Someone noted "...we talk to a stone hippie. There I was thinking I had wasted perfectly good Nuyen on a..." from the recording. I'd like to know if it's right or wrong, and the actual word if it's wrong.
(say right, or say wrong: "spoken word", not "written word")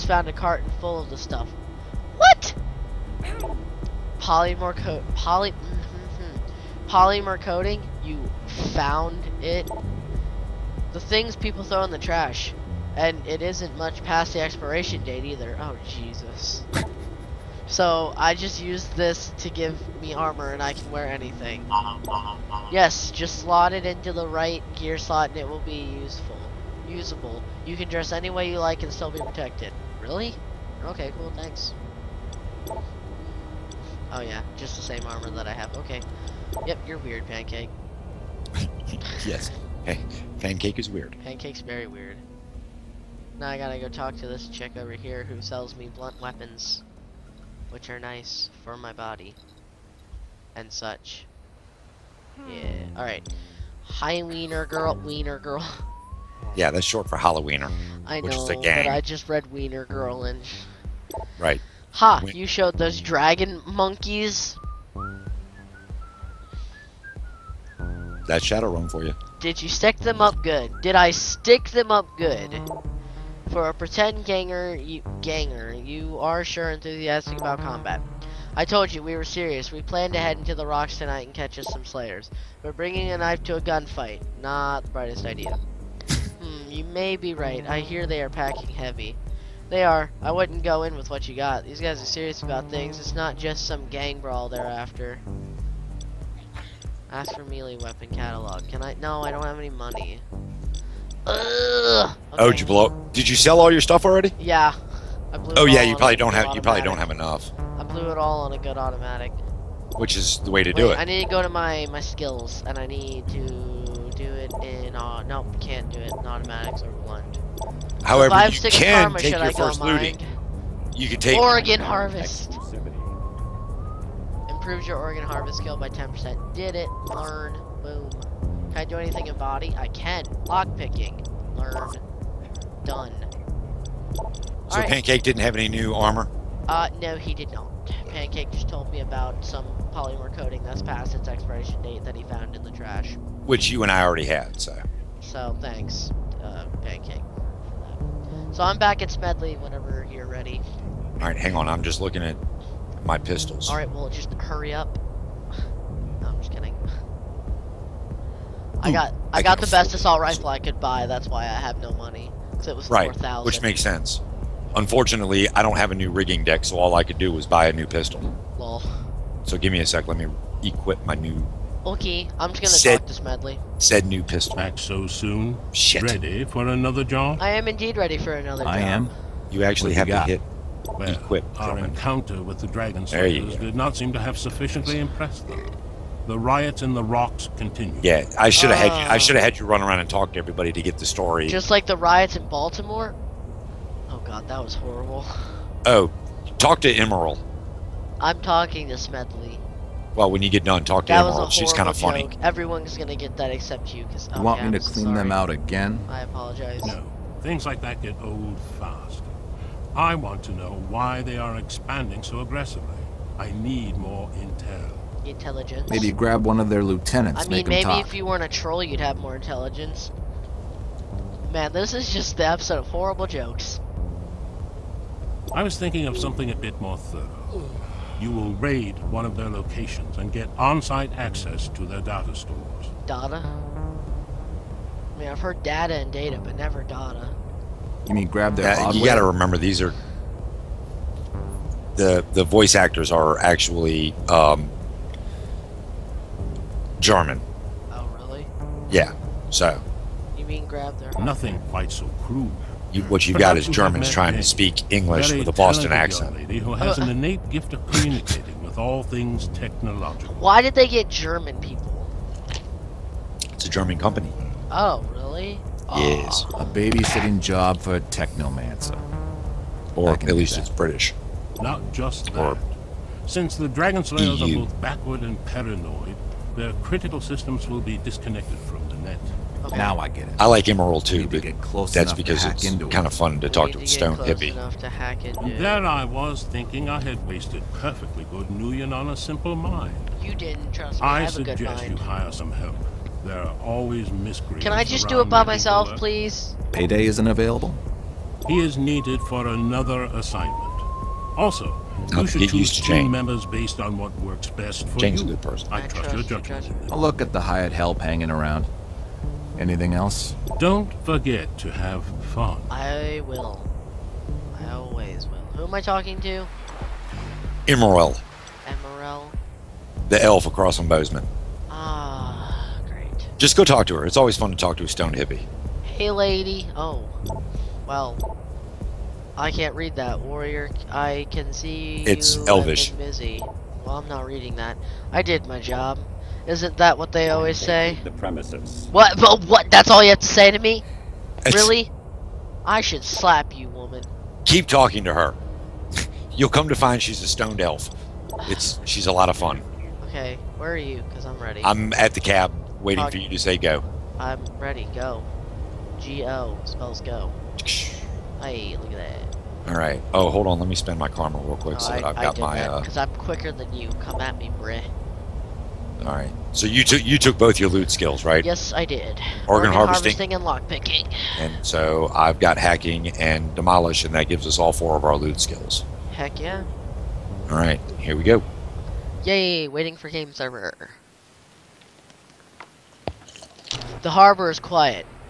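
right.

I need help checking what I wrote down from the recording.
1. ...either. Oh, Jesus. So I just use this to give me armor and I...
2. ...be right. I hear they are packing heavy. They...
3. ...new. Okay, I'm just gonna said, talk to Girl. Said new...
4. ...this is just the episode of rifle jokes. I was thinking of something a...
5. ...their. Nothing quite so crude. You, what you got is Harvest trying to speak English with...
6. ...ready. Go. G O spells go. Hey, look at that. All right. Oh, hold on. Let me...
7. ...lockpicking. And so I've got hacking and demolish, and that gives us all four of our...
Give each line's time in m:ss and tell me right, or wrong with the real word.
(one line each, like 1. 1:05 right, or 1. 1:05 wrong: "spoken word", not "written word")
1. 0:15 right
2. 1:27 right
3. 2:51 wrong: "Smedley", not "Girl"
4. 3:41 wrong: "horrible", not "rifle"
5. 4:10 wrong: "Germans", not "Harvest"
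6. 5:54 right
7. 6:10 right.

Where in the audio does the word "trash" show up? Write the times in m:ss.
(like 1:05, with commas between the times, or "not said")
0:12, 2:22.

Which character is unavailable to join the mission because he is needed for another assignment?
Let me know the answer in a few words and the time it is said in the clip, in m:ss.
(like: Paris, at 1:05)
Payday, at 4:56.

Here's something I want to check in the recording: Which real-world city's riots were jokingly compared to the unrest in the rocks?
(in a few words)
Baltimore.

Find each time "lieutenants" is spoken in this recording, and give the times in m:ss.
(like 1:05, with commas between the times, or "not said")
3:36.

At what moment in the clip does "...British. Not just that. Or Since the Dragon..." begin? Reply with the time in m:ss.
4:30.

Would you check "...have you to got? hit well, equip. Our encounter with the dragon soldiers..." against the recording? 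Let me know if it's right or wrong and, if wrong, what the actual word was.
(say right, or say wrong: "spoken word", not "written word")
right.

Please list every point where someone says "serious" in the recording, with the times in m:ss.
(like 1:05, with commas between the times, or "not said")
1:19, 1:32.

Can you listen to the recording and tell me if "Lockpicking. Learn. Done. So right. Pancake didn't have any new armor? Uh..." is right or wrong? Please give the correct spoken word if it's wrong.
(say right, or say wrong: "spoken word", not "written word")
right.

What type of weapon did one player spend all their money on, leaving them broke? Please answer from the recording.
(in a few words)
Assault rifle.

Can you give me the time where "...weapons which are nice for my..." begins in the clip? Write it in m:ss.
0:46.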